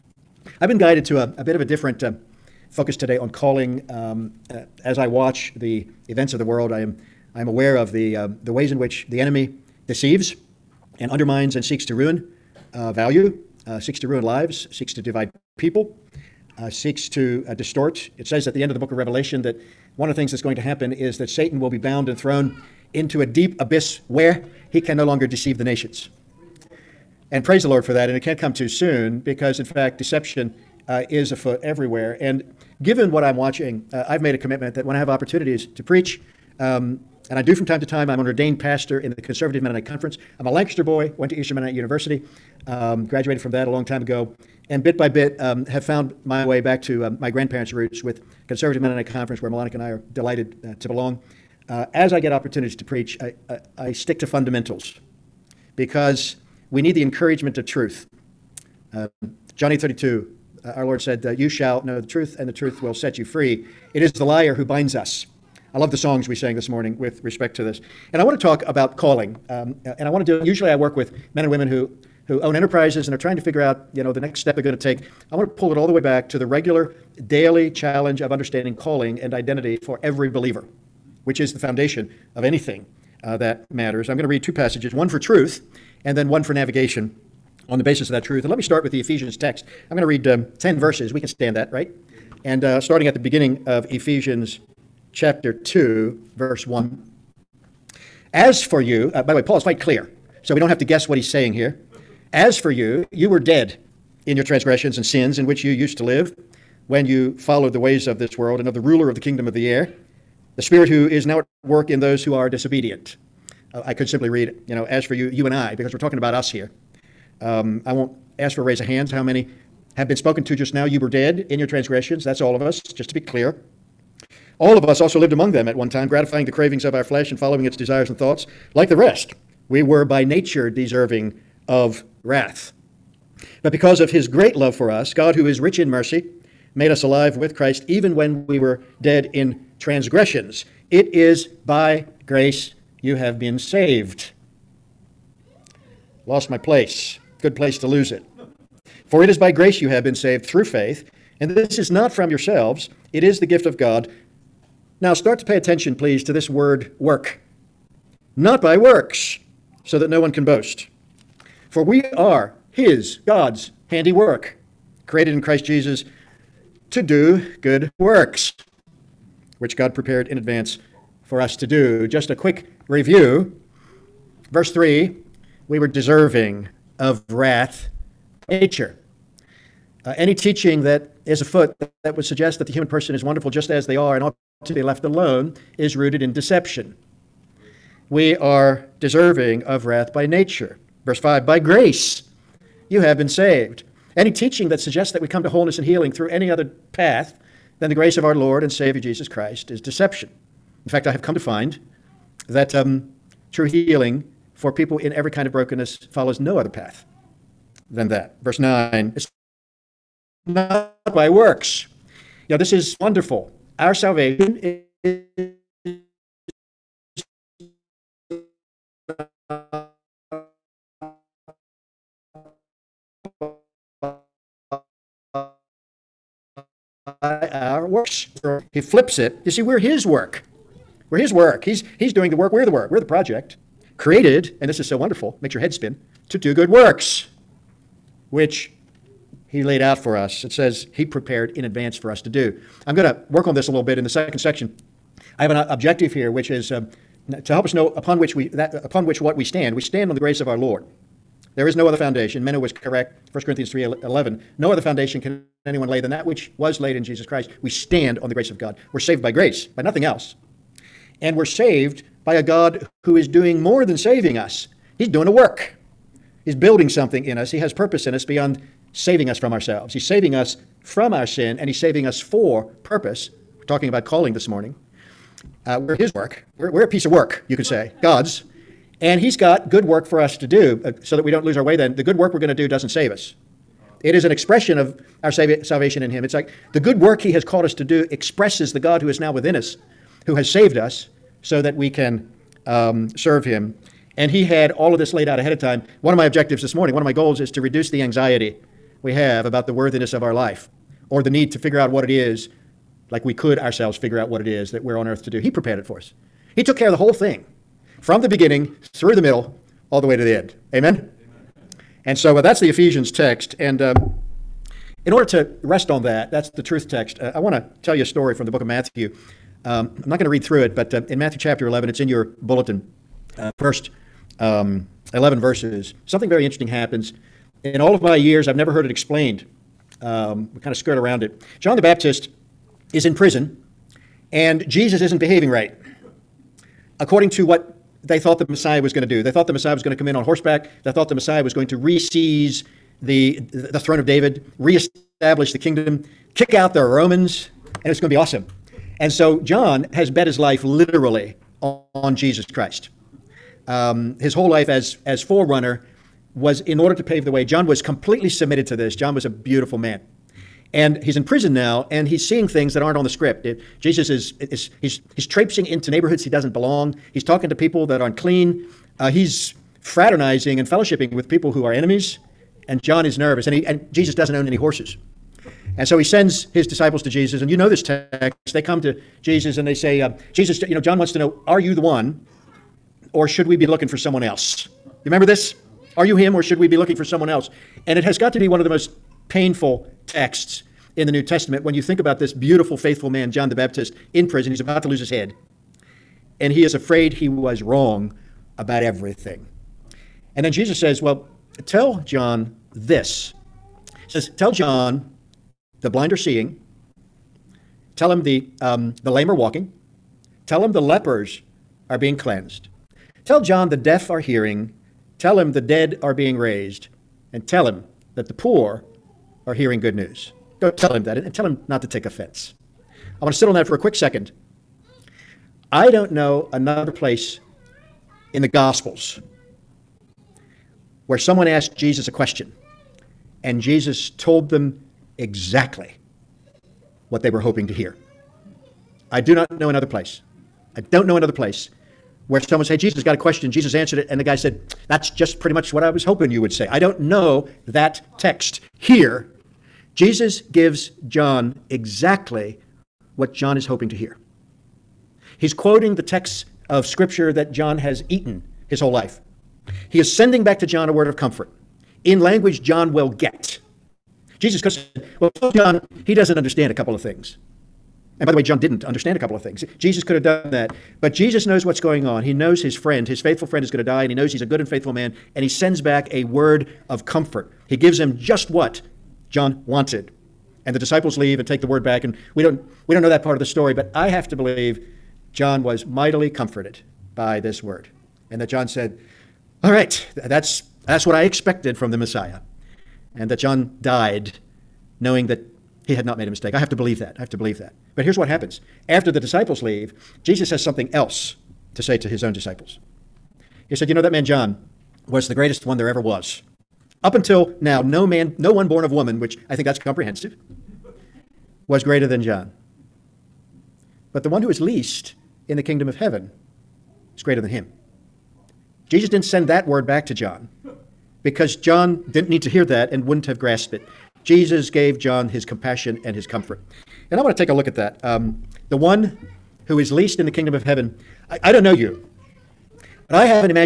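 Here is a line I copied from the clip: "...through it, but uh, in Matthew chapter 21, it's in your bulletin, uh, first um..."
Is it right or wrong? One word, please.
wrong.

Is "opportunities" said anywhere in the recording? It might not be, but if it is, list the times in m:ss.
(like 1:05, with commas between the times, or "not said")
0:35, 0:52.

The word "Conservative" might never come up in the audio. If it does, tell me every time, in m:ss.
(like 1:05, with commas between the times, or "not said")
0:39, 0:48.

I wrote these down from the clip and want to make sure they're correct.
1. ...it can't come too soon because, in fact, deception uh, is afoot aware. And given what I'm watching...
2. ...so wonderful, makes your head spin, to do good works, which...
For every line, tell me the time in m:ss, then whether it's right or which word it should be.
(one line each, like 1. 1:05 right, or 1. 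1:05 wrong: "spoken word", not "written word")
1. 0:28 wrong: "everywhere", not "aware"
2. 3:54 right.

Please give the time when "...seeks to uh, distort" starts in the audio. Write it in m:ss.
0:16.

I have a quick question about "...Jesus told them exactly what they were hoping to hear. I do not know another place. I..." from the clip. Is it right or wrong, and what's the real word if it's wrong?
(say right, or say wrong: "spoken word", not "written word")
right.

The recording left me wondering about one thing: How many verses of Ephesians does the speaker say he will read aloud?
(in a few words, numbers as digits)
10.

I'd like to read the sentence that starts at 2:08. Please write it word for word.
Like the rest, we were by nature deserving of wrath.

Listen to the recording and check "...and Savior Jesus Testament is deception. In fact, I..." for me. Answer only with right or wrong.
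wrong.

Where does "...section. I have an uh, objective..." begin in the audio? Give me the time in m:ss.
4:04.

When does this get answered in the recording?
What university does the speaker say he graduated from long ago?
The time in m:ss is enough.
0:41.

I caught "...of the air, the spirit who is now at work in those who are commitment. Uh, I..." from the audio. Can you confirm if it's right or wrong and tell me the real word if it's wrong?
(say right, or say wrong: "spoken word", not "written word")
wrong: "disobedient", not "commitment".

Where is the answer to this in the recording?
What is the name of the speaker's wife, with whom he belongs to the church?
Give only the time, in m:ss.
0:49.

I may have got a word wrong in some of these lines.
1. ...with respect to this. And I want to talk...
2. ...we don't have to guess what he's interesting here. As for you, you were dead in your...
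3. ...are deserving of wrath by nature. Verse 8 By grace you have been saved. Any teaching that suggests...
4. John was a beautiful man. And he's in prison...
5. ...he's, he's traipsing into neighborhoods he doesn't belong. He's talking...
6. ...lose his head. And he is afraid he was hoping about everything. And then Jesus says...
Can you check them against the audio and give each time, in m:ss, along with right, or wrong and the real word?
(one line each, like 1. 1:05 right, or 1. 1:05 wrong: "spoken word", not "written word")
1. 1:06 right
2. 1:40 wrong: "saying", not "interesting"
3. 3:08 wrong: "5", not "8"
4. 5:58 right
5. 6:04 right
6. 6:34 wrong: "wrong", not "hoping".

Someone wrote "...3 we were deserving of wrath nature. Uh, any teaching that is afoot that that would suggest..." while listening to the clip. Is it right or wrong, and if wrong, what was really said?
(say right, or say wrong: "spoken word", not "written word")
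right.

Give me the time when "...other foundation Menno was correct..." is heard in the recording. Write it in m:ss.
4:11.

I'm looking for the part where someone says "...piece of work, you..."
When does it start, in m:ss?
4:36.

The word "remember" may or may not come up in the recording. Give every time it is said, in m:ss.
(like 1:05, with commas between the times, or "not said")
6:25.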